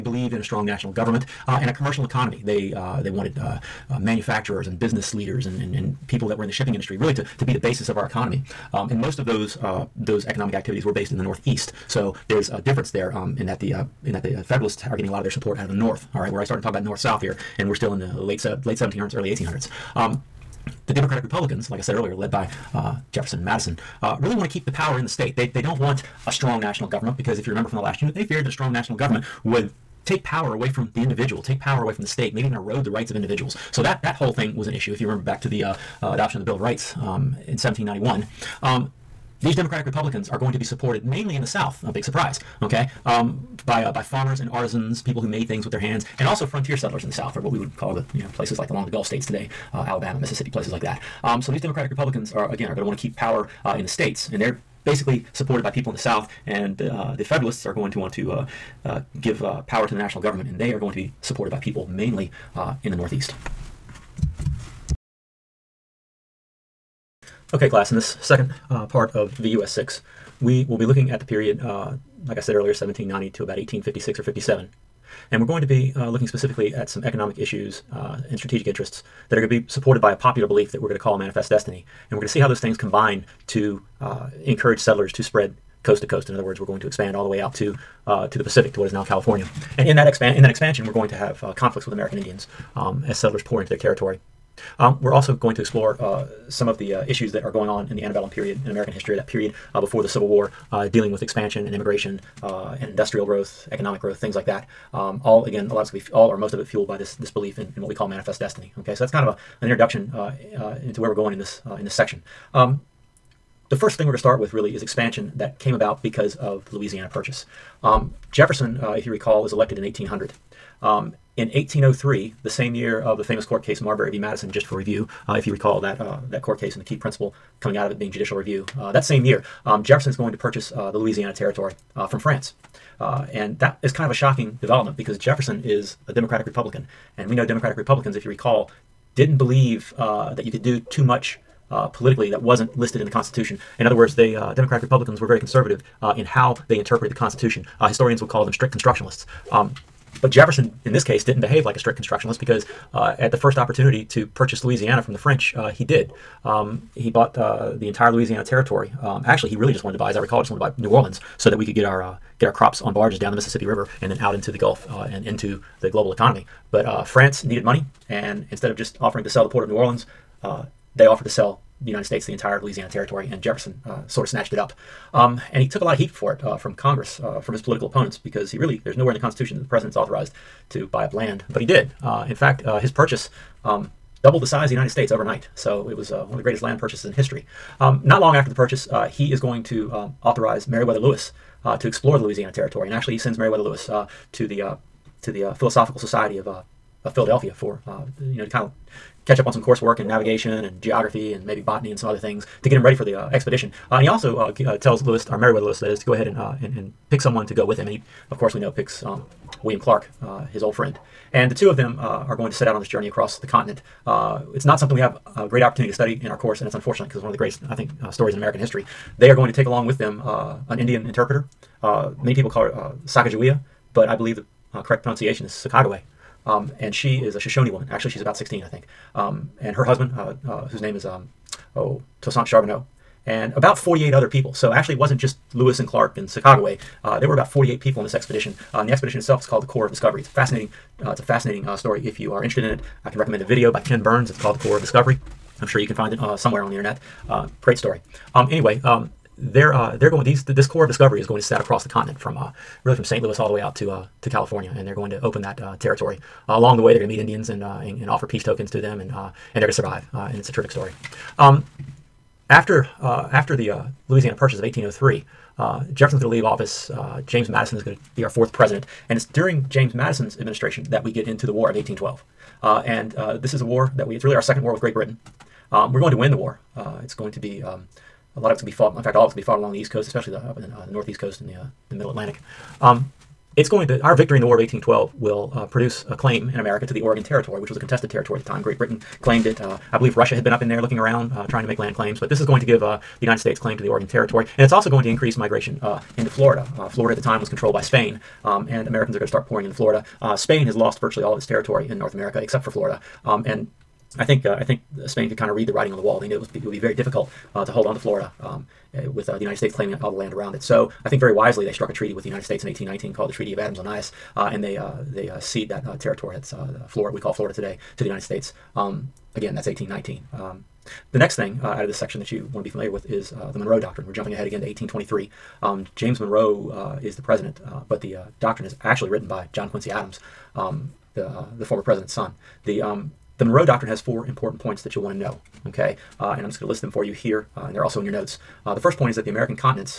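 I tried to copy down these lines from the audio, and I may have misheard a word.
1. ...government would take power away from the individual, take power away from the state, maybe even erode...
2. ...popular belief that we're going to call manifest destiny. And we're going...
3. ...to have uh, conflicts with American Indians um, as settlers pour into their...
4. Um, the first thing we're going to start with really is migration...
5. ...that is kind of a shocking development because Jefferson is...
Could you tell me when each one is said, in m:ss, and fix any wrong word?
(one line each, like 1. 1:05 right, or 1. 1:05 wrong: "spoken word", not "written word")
1. 0:28 right
2. 1:20 right
3. 1:31 right
4. 1:52 wrong: "expansion", not "migration"
5. 2:13 right.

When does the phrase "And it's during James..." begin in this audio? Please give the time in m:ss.
4:29.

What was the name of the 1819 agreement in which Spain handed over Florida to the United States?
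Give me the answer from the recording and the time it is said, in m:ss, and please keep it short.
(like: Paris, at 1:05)
Treaty of Adams-Onís, at 5:13.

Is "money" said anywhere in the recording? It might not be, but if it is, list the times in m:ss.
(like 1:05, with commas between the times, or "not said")
2:47.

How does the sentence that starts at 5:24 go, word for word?
We're jumping ahead again to 1823.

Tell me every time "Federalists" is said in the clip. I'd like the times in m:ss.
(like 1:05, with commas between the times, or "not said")
0:14, 0:57.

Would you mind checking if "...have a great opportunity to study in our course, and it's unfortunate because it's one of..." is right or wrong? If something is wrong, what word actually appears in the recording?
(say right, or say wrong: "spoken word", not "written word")
right.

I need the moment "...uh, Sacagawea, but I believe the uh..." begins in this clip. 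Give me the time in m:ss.
3:42.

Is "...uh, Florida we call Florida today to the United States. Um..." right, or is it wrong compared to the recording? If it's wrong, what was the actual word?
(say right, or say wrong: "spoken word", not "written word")
right.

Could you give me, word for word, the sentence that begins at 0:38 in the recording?
Um, these Democratic Republicans are going to be supported mainly in the South.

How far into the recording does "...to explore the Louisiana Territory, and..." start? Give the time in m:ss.
3:11.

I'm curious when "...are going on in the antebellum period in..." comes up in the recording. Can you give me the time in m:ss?
1:37.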